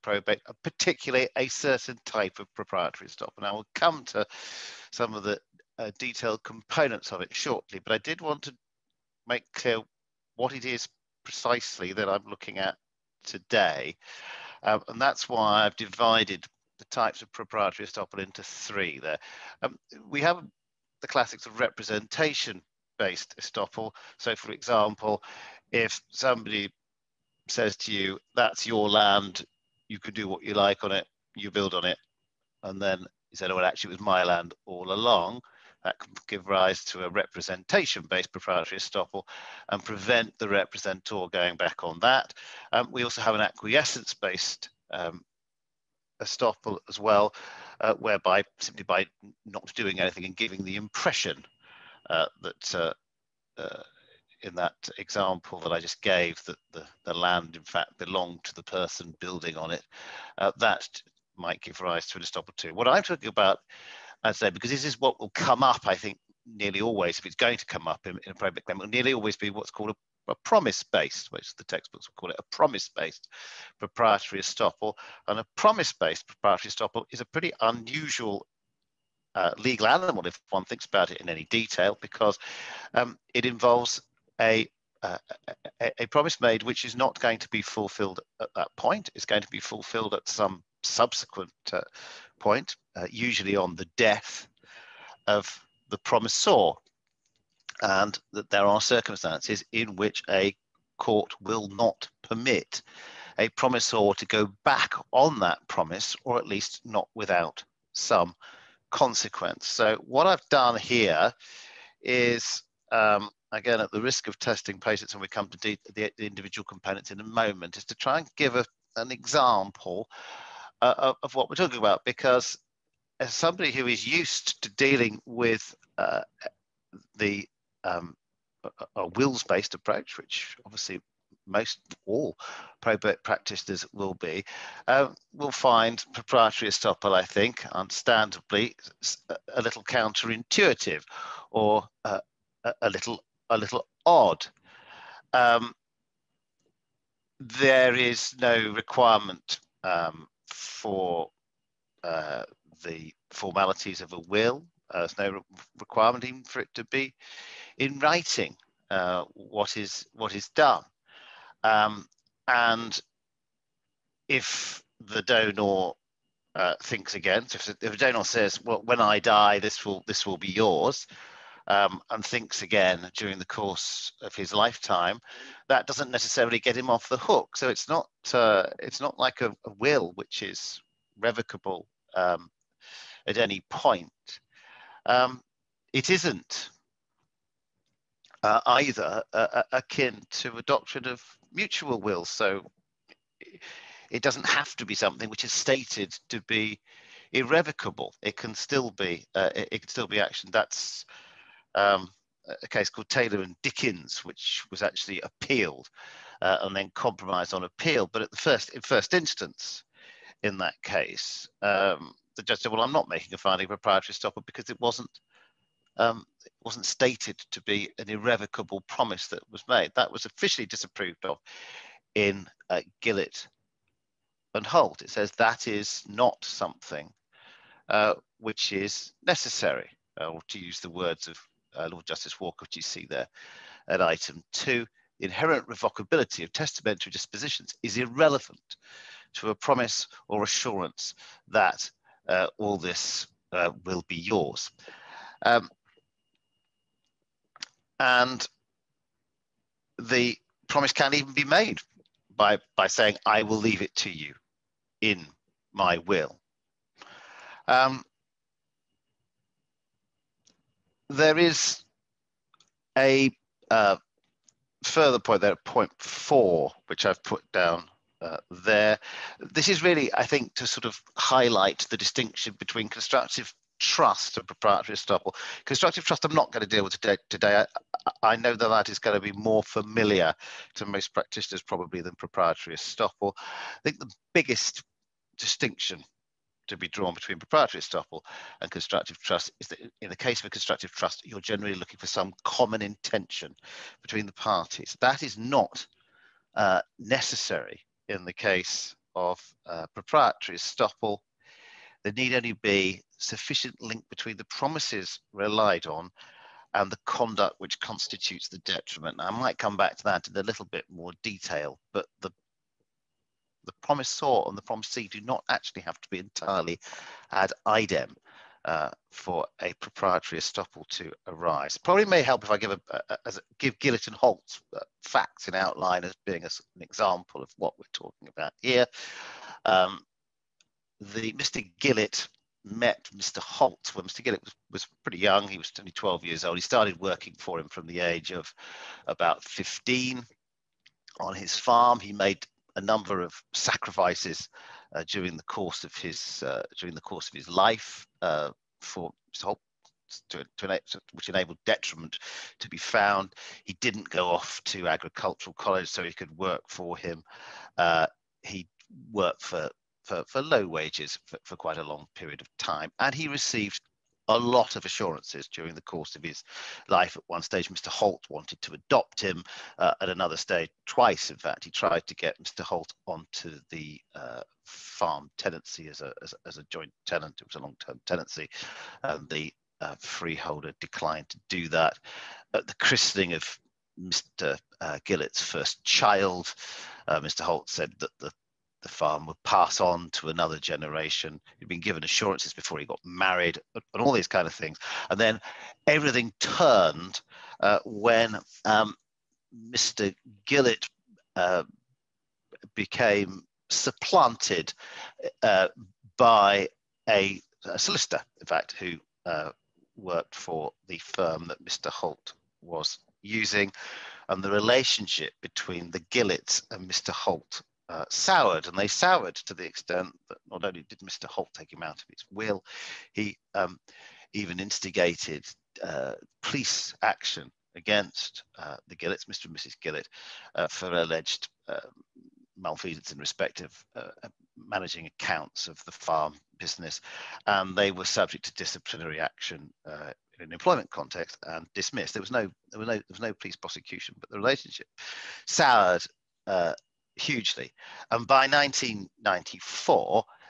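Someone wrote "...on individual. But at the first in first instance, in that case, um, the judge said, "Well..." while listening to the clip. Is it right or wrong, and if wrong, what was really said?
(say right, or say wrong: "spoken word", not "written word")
wrong: "appeal", not "individual".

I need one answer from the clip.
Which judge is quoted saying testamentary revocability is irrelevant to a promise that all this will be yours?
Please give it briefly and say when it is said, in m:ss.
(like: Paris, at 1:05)
Lord Justice Walker, at 3:51.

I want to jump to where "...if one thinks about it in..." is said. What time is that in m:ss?
1:20.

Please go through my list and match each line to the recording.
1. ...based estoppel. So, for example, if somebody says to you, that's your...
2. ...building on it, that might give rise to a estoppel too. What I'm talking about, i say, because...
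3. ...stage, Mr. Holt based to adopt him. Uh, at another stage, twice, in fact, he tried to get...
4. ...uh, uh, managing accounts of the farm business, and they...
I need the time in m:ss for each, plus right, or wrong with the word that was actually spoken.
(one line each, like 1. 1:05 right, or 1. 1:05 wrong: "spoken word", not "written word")
1. 0:22 right
2. 0:59 right
3. 6:07 wrong: "wanted", not "based"
4. 7:13 right.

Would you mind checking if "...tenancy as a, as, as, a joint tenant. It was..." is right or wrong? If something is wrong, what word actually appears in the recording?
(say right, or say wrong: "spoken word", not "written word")
right.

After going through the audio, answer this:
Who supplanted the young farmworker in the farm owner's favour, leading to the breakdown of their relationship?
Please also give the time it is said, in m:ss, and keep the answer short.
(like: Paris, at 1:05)
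a solicitor, at 6:47.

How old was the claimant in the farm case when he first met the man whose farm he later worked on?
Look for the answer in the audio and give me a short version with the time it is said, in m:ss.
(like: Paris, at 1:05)
12, at 5:35.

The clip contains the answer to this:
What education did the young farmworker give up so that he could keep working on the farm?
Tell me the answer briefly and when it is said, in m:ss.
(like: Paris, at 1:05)
agricultural college, at 5:54.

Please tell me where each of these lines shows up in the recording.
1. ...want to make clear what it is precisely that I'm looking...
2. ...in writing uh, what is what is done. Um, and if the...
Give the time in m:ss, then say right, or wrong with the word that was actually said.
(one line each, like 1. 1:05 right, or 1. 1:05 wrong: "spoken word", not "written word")
1. 0:08 right
2. 2:37 right.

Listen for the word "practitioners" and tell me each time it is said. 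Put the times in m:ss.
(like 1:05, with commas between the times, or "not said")
2:13, 4:41.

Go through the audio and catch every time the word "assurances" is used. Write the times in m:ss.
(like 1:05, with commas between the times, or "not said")
4:00, 6:04, 6:32.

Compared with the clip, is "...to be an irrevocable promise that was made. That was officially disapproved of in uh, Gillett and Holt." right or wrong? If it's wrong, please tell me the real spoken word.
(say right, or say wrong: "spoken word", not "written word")
right.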